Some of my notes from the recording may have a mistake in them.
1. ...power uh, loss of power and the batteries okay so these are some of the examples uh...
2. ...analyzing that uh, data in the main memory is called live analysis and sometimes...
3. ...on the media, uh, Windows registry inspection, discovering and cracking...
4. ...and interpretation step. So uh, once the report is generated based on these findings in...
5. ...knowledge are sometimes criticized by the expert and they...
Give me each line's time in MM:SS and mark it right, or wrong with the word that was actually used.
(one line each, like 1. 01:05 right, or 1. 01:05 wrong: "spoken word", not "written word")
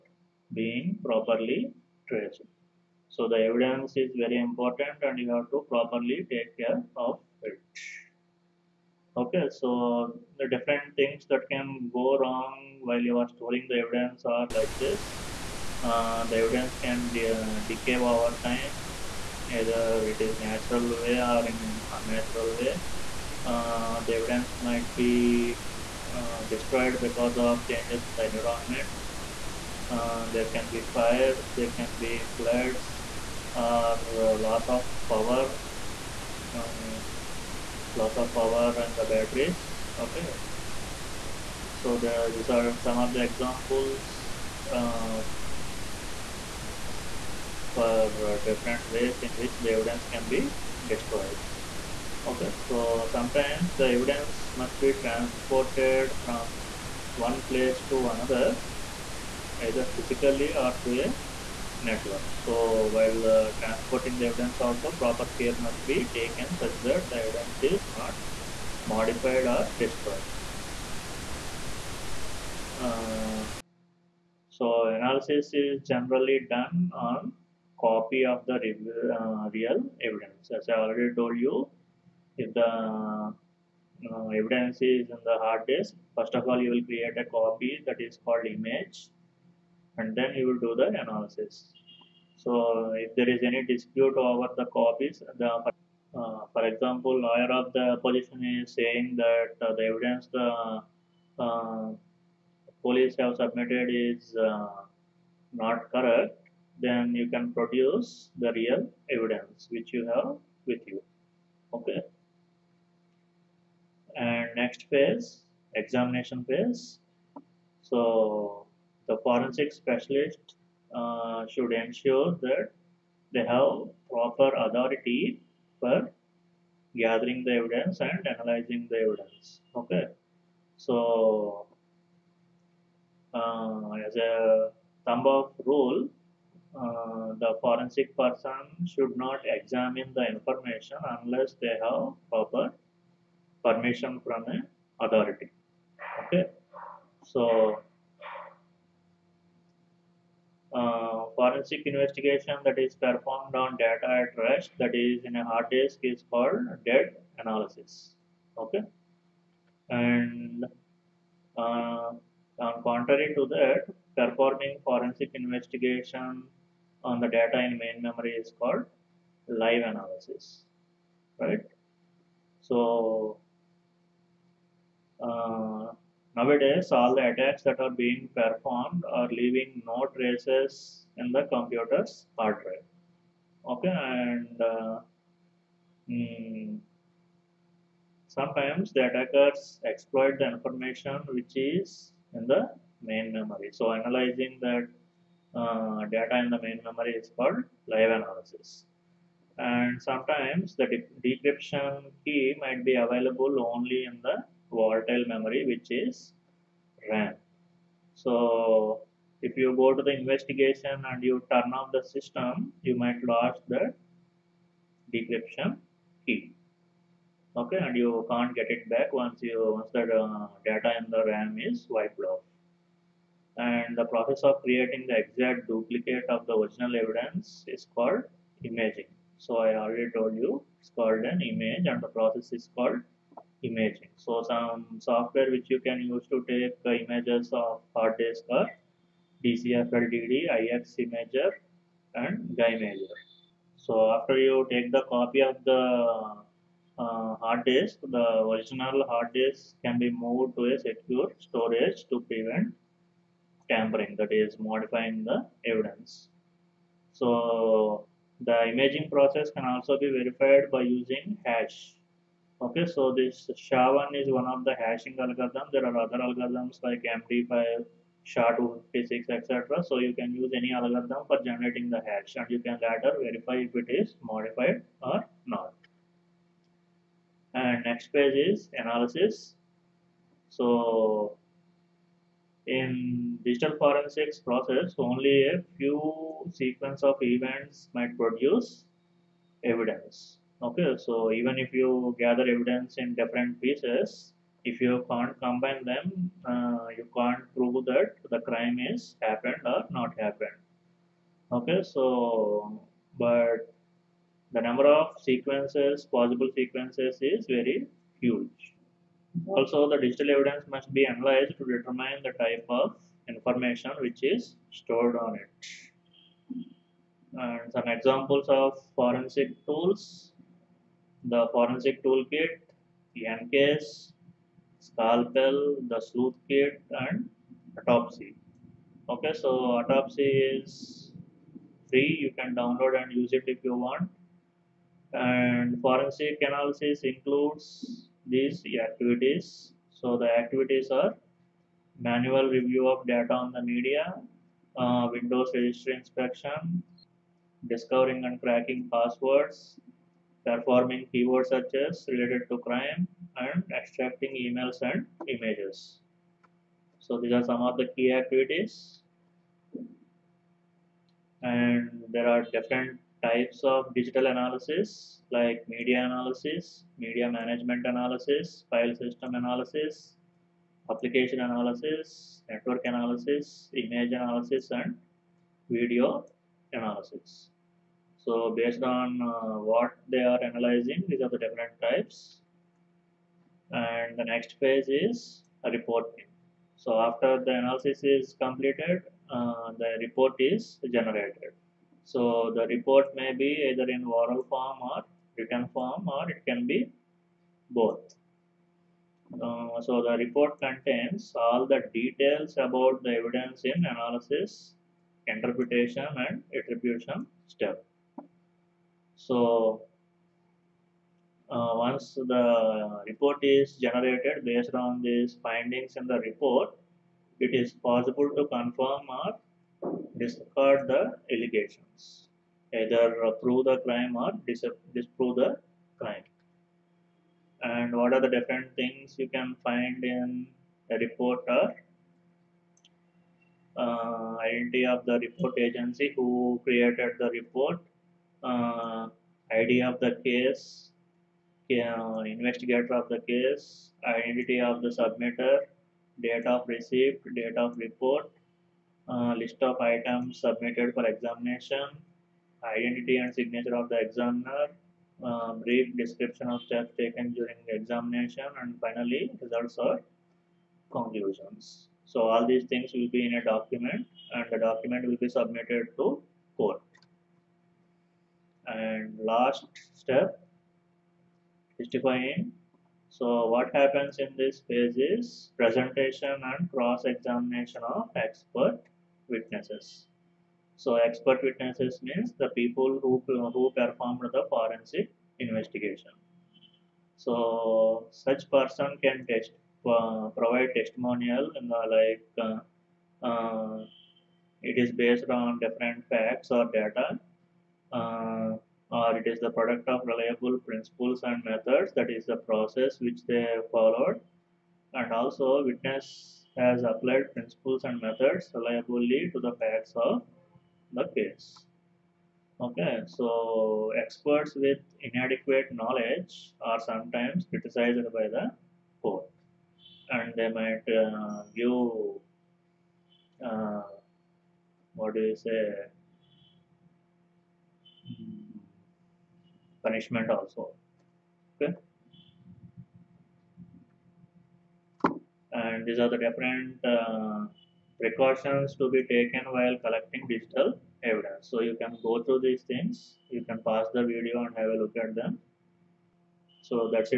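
1. 00:35 right
2. 03:13 right
3. 05:43 right
4. 06:46 wrong: "attribution", not "interpretation"
5. 08:35 wrong: "court", not "expert".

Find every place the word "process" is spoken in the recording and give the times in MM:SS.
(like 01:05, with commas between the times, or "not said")
03:44, 03:52, 04:19, 04:44, 08:22.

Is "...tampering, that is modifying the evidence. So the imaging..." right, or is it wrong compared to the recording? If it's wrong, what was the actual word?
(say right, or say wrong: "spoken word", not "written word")
right.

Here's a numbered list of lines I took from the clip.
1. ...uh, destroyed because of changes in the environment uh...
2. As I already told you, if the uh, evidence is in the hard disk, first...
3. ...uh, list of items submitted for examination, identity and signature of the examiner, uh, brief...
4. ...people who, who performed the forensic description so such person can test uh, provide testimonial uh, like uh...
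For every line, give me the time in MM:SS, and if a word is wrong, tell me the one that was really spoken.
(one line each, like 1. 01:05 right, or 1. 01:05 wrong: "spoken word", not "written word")
1. 00:26 right
2. 01:20 right
3. 07:29 right
4. 08:02 wrong: "investigation", not "description".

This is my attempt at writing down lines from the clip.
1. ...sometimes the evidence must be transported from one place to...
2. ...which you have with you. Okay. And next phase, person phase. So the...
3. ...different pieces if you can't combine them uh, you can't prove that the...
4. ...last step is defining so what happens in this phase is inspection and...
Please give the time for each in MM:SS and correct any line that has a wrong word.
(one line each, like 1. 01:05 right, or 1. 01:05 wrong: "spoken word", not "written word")
1. 00:53 right
2. 01:49 wrong: "examination", not "person"
3. 04:53 right
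4. 07:49 wrong: "presentation", not "inspection".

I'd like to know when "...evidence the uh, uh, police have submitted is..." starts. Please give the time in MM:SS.
01:39.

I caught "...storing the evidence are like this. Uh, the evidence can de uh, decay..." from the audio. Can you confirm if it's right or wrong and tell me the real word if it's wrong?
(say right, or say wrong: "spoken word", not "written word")
right.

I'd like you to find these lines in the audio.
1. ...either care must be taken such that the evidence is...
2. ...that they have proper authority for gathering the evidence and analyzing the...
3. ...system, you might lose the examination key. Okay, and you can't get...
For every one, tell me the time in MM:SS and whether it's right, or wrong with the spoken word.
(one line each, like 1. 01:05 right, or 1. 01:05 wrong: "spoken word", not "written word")
1. 01:04 wrong: "proper", not "either"
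2. 02:02 right
3. 03:32 wrong: "decryption", not "examination".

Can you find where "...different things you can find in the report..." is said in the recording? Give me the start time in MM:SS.
07:08.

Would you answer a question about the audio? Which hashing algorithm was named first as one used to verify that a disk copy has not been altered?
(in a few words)
SHA-1.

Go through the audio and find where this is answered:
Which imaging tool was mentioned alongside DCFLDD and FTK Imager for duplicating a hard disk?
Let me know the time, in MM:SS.
04:02.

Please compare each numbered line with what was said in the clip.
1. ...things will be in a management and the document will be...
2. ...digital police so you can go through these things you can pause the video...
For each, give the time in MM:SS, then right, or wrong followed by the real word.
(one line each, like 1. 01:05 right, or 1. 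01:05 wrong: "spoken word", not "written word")
1. 07:42 wrong: "document", not "management"
2. 09:00 wrong: "evidence", not "police".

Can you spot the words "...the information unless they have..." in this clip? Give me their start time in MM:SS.
02:20.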